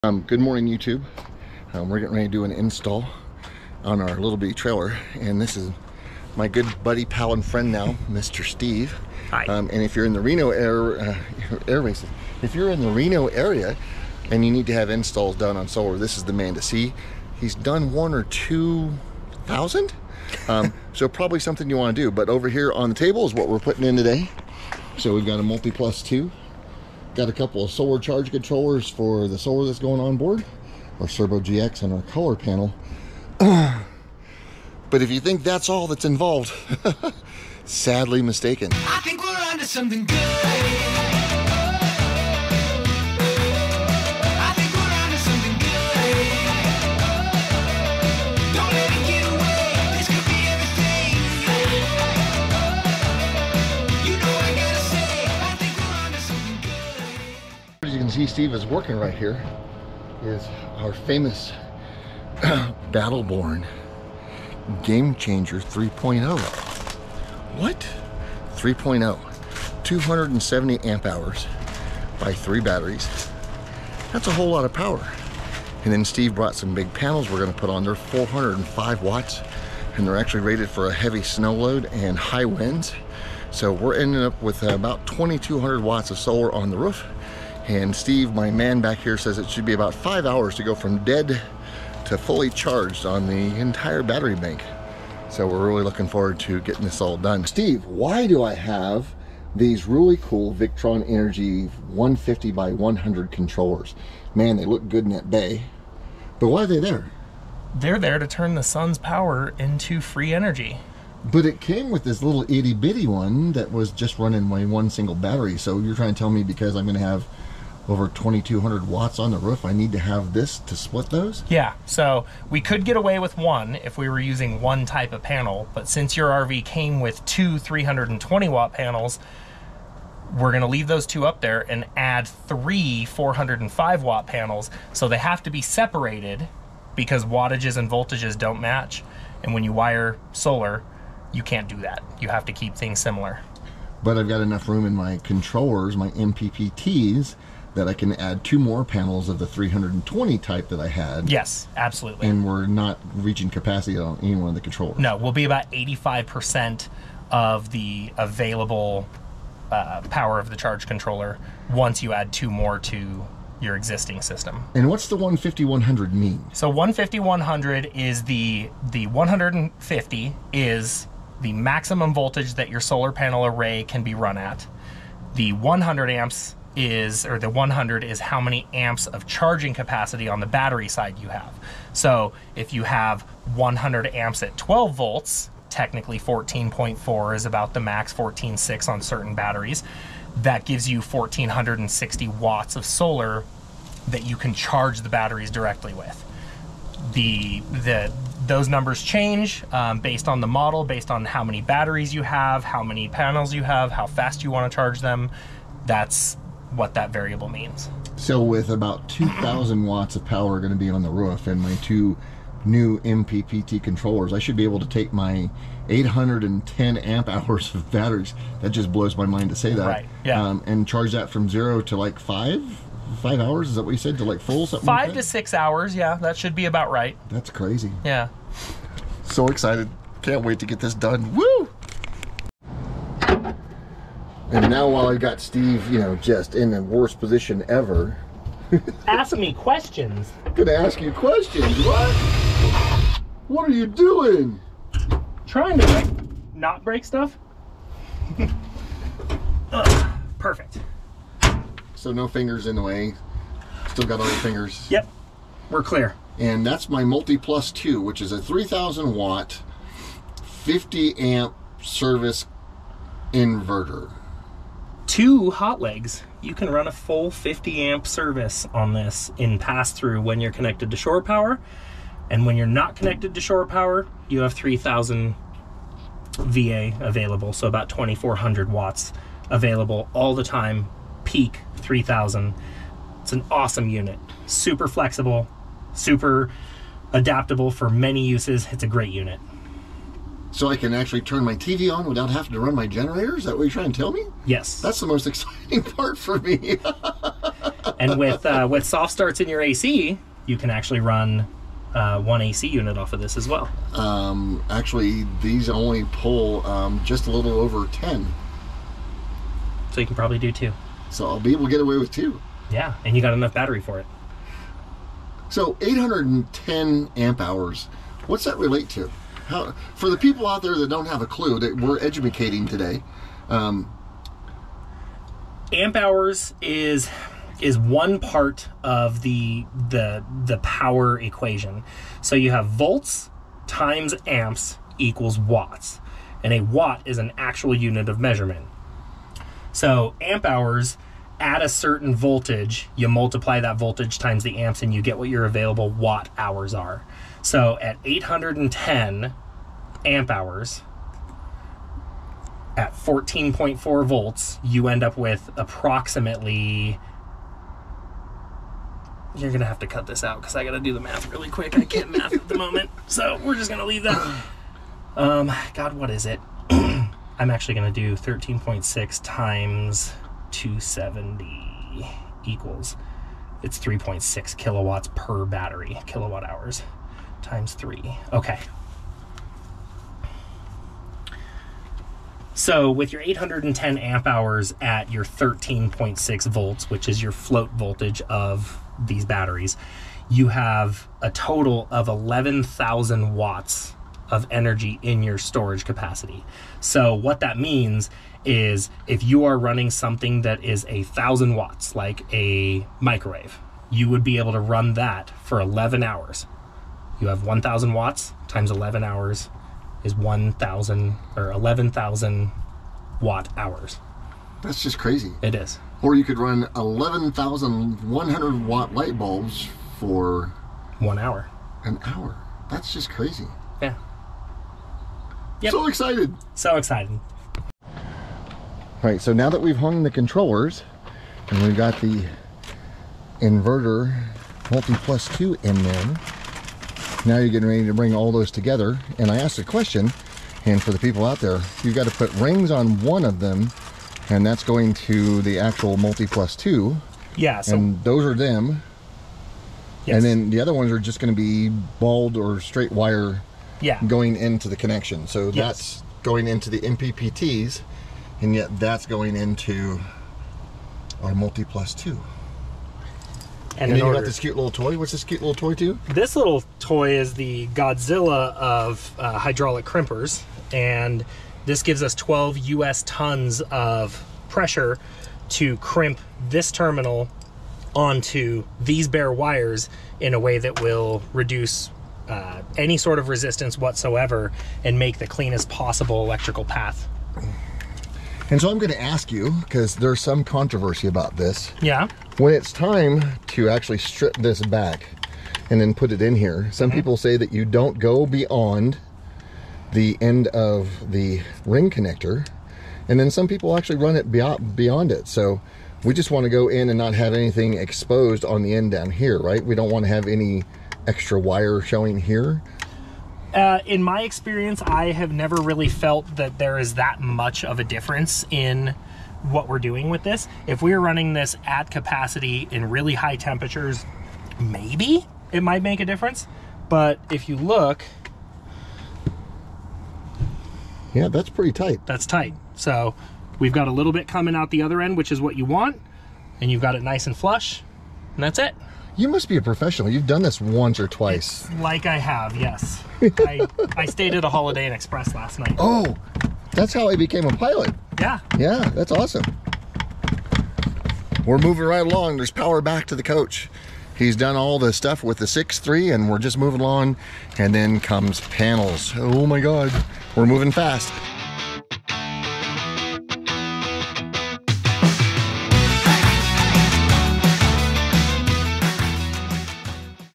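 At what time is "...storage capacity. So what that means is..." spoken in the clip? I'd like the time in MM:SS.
06:35.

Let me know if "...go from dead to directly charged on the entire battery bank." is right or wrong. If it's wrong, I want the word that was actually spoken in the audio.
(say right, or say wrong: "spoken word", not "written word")
wrong: "fully", not "directly".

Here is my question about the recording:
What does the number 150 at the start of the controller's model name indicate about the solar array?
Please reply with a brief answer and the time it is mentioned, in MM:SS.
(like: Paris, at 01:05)
maximum voltage, at 02:51.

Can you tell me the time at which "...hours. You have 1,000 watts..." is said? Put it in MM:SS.
06:46.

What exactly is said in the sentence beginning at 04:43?
It's an awesome unit, super flexible, super adaptable for many uses.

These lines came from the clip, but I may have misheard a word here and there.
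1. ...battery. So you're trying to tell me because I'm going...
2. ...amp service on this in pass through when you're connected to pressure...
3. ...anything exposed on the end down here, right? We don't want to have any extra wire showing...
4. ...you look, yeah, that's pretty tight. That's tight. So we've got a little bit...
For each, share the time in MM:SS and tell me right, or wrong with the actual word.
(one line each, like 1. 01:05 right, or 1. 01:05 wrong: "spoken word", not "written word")
1. 01:55 right
2. 04:27 wrong: "shore", not "pressure"
3. 08:27 right
4. 08:47 right.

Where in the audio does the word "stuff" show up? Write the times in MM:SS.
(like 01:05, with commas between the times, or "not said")
04:07, 09:14.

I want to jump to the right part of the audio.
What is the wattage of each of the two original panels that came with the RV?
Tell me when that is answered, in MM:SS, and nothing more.
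02:07.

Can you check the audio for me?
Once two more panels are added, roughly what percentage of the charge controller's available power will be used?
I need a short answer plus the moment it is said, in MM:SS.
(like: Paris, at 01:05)
85%, at 02:35.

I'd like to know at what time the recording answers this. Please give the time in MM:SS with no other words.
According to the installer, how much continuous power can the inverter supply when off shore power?
04:37.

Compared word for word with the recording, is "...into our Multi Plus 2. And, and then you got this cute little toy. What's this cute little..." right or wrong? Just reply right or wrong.
right.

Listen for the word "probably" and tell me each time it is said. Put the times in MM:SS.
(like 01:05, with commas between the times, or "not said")
00:21, 05:10.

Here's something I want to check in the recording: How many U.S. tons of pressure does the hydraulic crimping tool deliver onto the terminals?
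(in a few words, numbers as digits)
12 tons.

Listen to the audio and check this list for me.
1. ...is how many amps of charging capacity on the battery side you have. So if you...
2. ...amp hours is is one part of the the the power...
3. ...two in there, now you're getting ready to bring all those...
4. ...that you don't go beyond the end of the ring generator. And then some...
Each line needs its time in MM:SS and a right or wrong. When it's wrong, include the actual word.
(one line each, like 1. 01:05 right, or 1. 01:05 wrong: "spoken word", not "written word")
1. 02:58 right
2. 05:25 right
3. 07:15 right
4. 08:17 wrong: "connector", not "generator".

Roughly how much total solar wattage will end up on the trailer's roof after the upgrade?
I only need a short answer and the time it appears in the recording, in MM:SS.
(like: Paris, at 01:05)
2,200 watts, at 01:24.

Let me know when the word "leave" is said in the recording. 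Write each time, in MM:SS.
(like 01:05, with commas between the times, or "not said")
02:10, 06:03.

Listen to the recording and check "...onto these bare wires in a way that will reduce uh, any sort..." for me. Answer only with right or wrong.
right.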